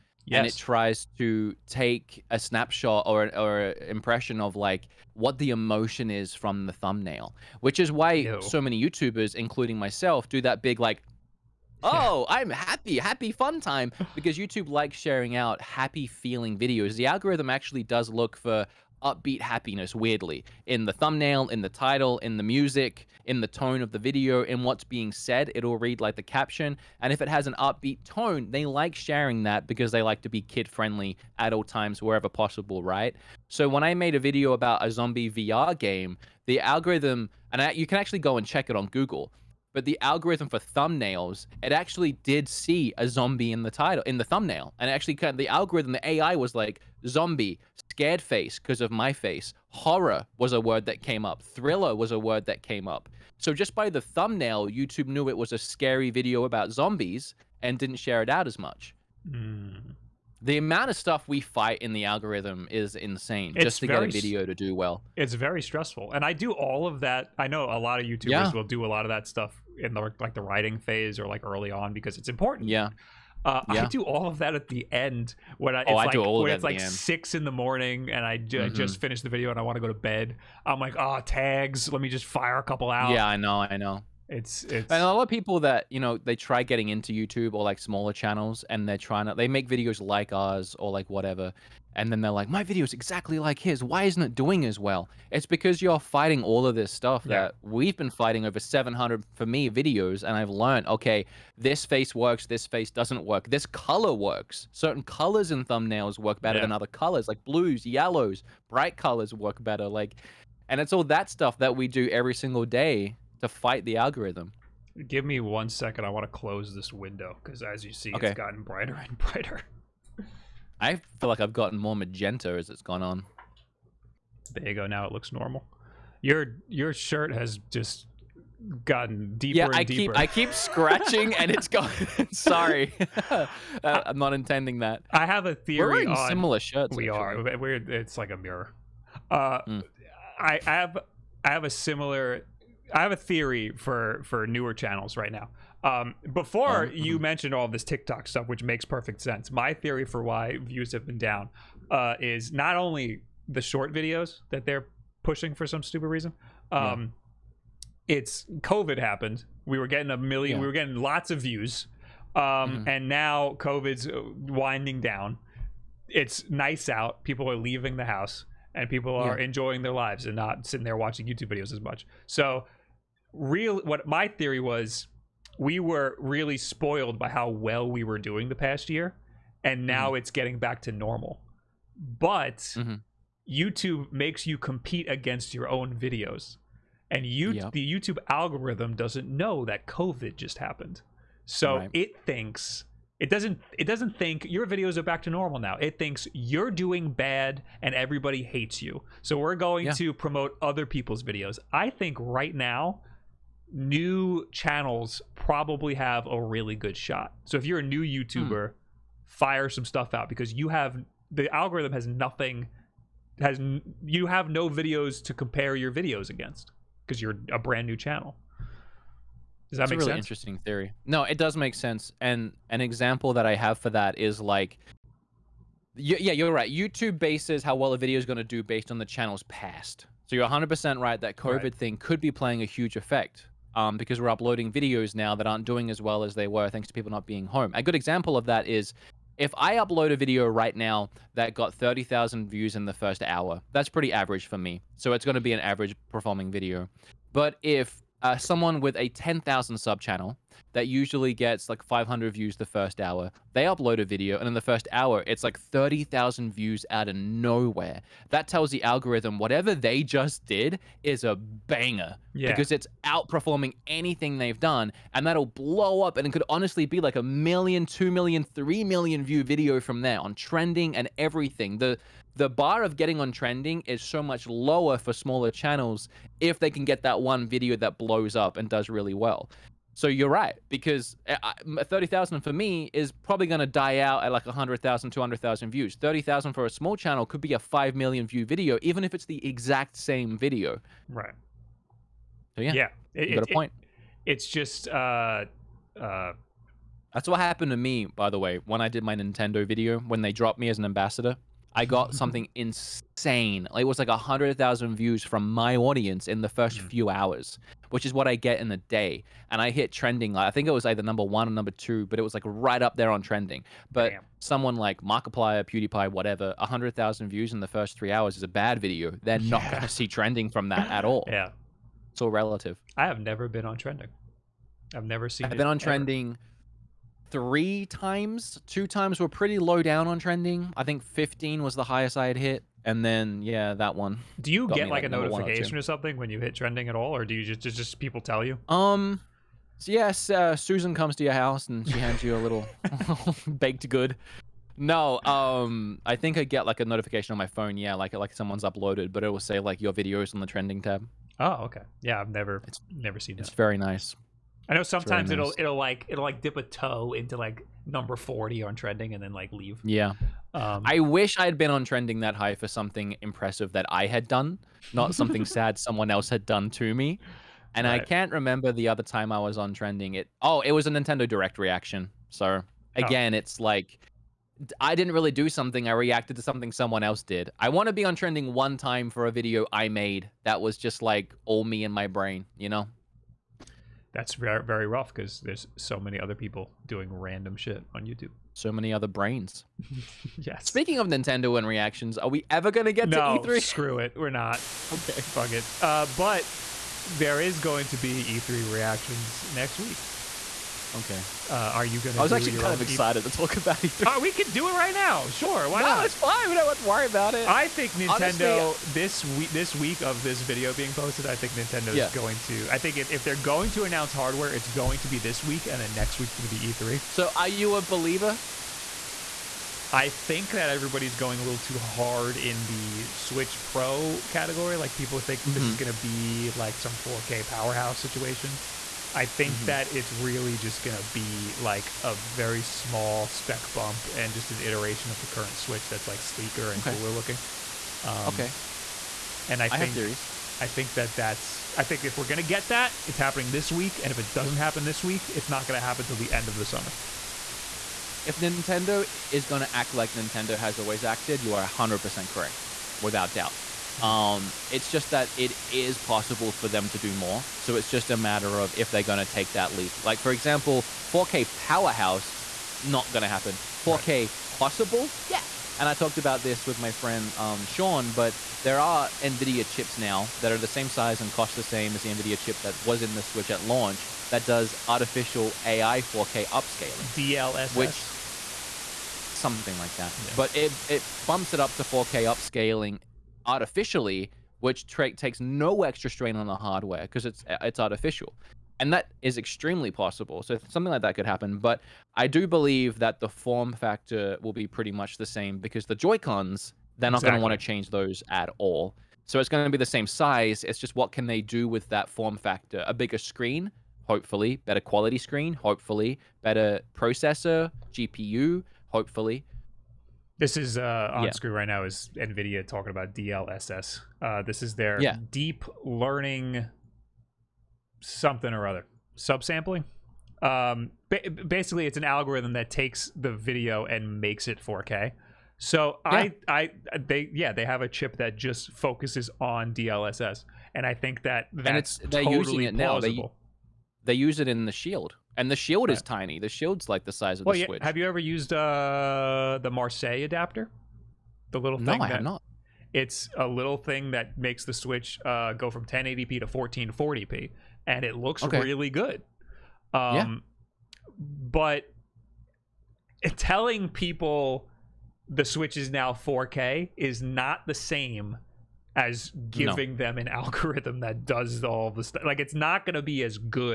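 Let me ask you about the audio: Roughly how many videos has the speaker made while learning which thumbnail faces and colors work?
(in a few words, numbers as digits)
700.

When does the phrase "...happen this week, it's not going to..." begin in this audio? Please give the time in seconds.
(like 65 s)
444 s.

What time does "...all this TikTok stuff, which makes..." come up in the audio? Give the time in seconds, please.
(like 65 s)
147 s.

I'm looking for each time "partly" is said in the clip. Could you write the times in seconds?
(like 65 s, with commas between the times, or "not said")
not said.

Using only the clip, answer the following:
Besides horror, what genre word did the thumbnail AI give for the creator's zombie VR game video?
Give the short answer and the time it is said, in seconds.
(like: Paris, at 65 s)
Thriller, at 51 s.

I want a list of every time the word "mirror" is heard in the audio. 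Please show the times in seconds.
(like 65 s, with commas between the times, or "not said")
138 s.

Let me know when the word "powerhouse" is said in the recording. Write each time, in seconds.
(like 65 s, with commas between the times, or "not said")
427 s, 461 s.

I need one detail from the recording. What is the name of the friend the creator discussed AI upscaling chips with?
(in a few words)
Sean.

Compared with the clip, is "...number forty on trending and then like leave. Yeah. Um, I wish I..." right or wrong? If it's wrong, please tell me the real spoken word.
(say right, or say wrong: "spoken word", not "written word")
right.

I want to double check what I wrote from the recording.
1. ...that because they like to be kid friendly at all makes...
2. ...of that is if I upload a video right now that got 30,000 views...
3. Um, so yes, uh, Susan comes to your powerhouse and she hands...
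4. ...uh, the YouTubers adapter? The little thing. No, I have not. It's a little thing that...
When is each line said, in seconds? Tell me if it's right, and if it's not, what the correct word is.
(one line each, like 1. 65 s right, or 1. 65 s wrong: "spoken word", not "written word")
1. 29 s wrong: "times", not "makes"
2. 238 s right
3. 338 s wrong: "house", not "powerhouse"
4. 538 s wrong: "Marseille", not "YouTubers".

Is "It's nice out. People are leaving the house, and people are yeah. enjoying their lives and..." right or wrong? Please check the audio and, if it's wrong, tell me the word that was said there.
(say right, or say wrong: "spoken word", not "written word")
right.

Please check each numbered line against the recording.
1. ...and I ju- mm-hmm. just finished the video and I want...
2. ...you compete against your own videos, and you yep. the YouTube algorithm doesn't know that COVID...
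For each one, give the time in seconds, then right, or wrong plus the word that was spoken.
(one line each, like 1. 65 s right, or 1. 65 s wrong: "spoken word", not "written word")
1. 78 s right
2. 184 s right.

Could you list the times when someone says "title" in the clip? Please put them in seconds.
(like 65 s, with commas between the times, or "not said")
21 s, 43 s.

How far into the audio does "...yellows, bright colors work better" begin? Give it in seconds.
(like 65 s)
107 s.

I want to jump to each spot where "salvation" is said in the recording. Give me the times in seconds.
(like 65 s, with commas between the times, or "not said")
not said.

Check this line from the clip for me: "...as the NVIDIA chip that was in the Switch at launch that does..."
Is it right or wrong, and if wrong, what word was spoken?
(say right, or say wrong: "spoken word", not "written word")
right.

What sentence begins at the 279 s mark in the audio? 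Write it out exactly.
So you're right because uh, 30,000 for me is probably going to die out at like 100,000, 200,000 views.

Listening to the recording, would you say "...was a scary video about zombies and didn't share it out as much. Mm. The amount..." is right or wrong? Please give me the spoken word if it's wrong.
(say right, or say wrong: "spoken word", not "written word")
right.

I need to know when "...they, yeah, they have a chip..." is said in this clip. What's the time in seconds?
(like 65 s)
526 s.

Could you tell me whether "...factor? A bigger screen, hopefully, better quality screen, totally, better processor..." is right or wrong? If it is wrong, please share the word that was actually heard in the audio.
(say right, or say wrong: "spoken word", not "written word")
wrong: "hopefully", not "totally".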